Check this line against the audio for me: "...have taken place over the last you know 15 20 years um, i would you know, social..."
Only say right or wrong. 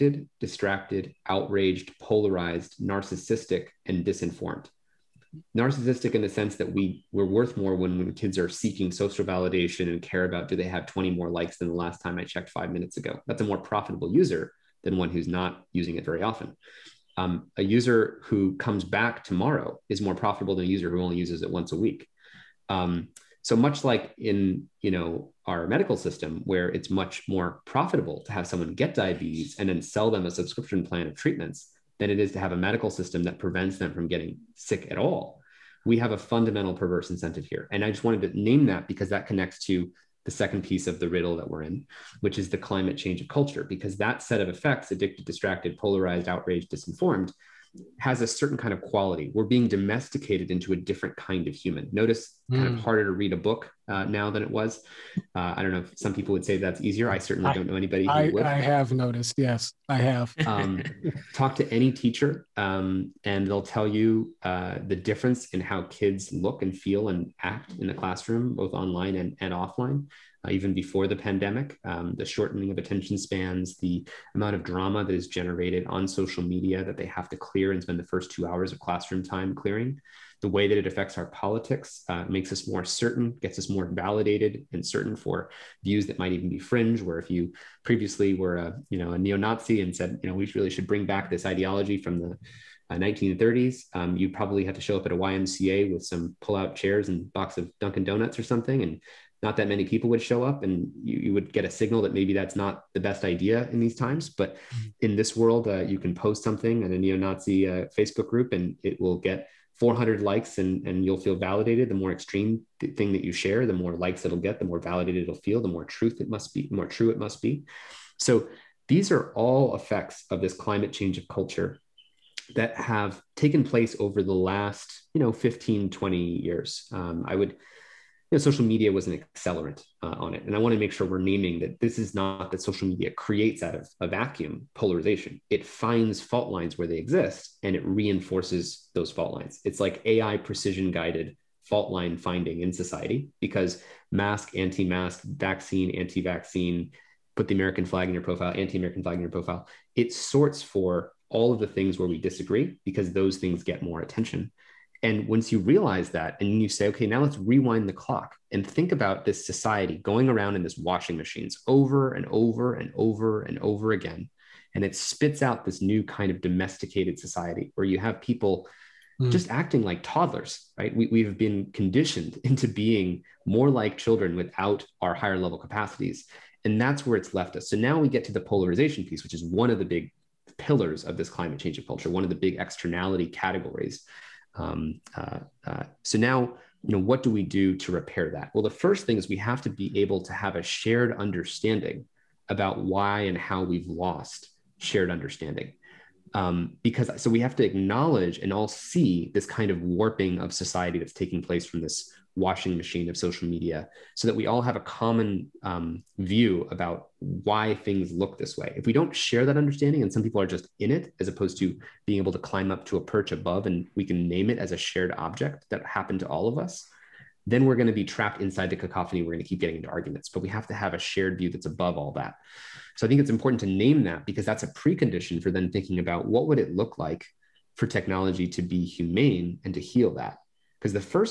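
right.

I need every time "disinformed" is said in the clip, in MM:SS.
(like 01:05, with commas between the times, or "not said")
00:04, 00:46.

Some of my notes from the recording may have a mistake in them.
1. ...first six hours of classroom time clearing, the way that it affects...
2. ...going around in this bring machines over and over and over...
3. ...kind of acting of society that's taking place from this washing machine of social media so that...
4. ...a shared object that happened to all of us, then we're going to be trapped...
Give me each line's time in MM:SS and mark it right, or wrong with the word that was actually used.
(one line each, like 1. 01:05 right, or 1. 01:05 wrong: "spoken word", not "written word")
1. 01:18 wrong: "two", not "six"
2. 02:39 wrong: "washing", not "bring"
3. 03:19 wrong: "warping", not "acting"
4. 03:34 right.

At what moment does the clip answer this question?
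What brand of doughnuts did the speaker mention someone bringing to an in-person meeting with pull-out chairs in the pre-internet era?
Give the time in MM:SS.
01:37.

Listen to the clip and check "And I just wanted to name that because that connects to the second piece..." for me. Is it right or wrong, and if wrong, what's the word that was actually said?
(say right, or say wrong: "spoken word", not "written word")
right.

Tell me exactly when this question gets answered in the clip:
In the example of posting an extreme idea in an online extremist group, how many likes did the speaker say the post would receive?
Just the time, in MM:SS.
01:49.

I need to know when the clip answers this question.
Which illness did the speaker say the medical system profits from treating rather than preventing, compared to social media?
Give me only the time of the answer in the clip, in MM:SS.
00:28.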